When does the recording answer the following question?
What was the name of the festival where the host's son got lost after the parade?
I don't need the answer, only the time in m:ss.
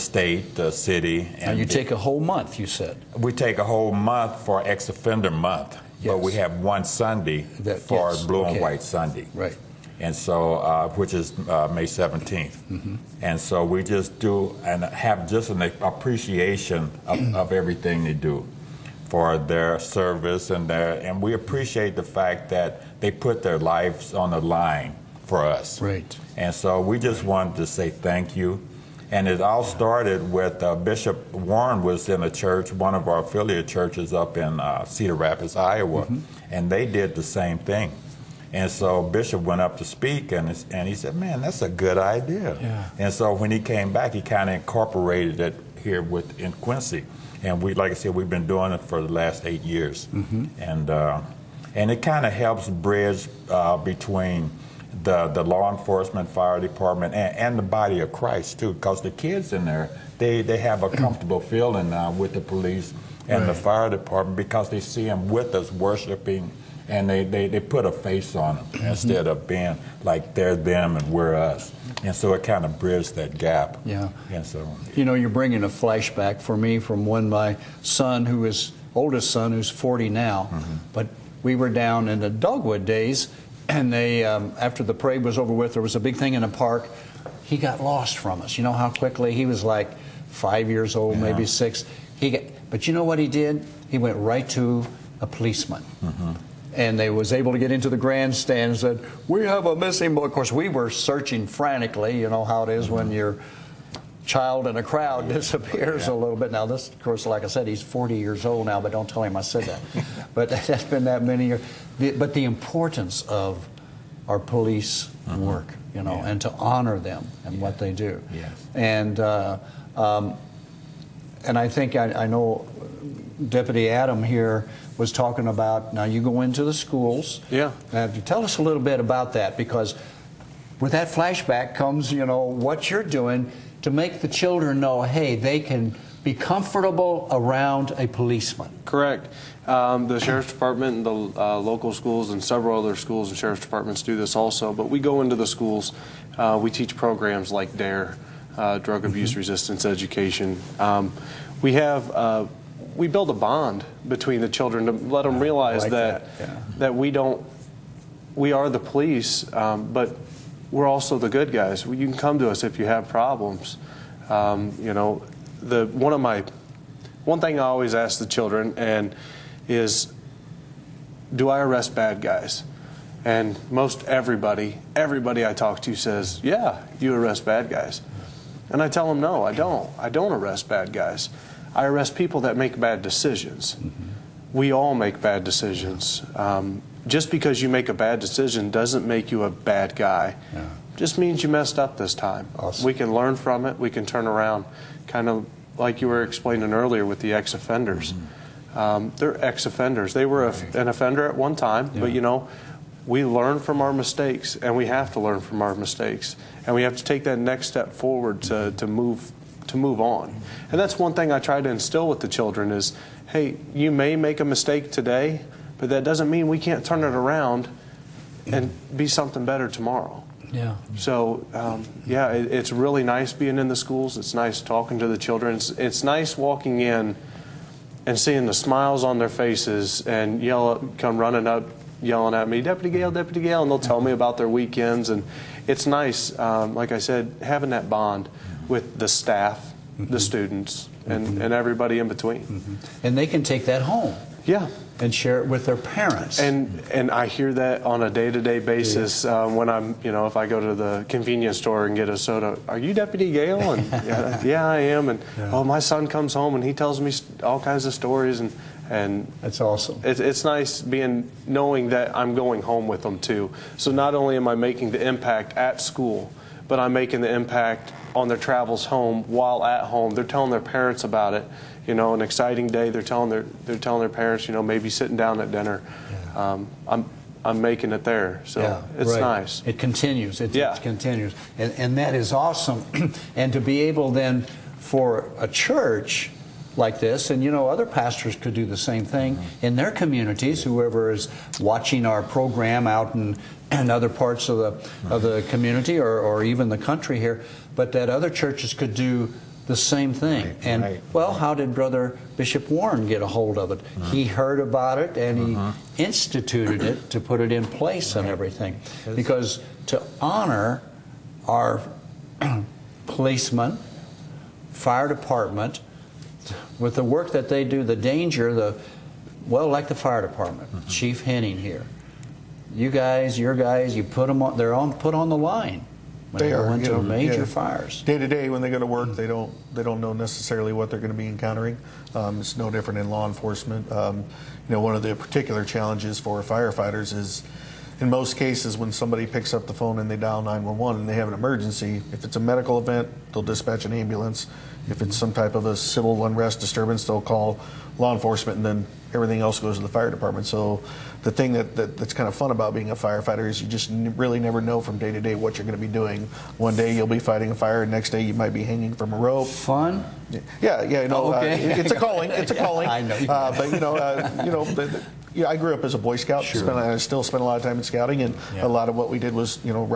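1:22.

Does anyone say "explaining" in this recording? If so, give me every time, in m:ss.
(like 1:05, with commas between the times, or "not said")
3:16.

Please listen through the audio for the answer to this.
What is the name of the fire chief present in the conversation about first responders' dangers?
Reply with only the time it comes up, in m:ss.
5:20.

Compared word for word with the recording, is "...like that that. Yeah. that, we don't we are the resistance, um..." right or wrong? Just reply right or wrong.
wrong.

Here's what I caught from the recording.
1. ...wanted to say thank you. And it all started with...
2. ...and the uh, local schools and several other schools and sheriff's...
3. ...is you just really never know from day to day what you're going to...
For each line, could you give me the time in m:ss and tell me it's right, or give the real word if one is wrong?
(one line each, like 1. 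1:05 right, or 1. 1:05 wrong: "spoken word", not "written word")
1. 0:27 right
2. 2:20 right
3. 5:53 right.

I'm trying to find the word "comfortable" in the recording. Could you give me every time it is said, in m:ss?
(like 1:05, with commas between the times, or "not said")
1:00, 2:16.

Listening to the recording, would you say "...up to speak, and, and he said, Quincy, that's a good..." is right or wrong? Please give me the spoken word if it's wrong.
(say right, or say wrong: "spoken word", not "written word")
wrong: "Man", not "Quincy".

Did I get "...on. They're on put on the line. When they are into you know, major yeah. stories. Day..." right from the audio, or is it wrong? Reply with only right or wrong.
wrong.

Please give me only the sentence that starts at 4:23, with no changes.
So not only am I making the impact at school, but I'm making the impact on their travels home while at home.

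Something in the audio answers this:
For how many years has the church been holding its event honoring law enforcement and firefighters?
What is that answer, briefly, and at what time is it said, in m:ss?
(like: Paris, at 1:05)
8, at 0:49.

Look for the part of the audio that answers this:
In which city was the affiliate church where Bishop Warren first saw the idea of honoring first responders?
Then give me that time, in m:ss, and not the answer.
0:34.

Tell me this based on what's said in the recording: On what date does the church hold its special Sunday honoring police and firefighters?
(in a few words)
May 17th.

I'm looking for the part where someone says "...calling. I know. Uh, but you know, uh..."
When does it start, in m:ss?
6:02.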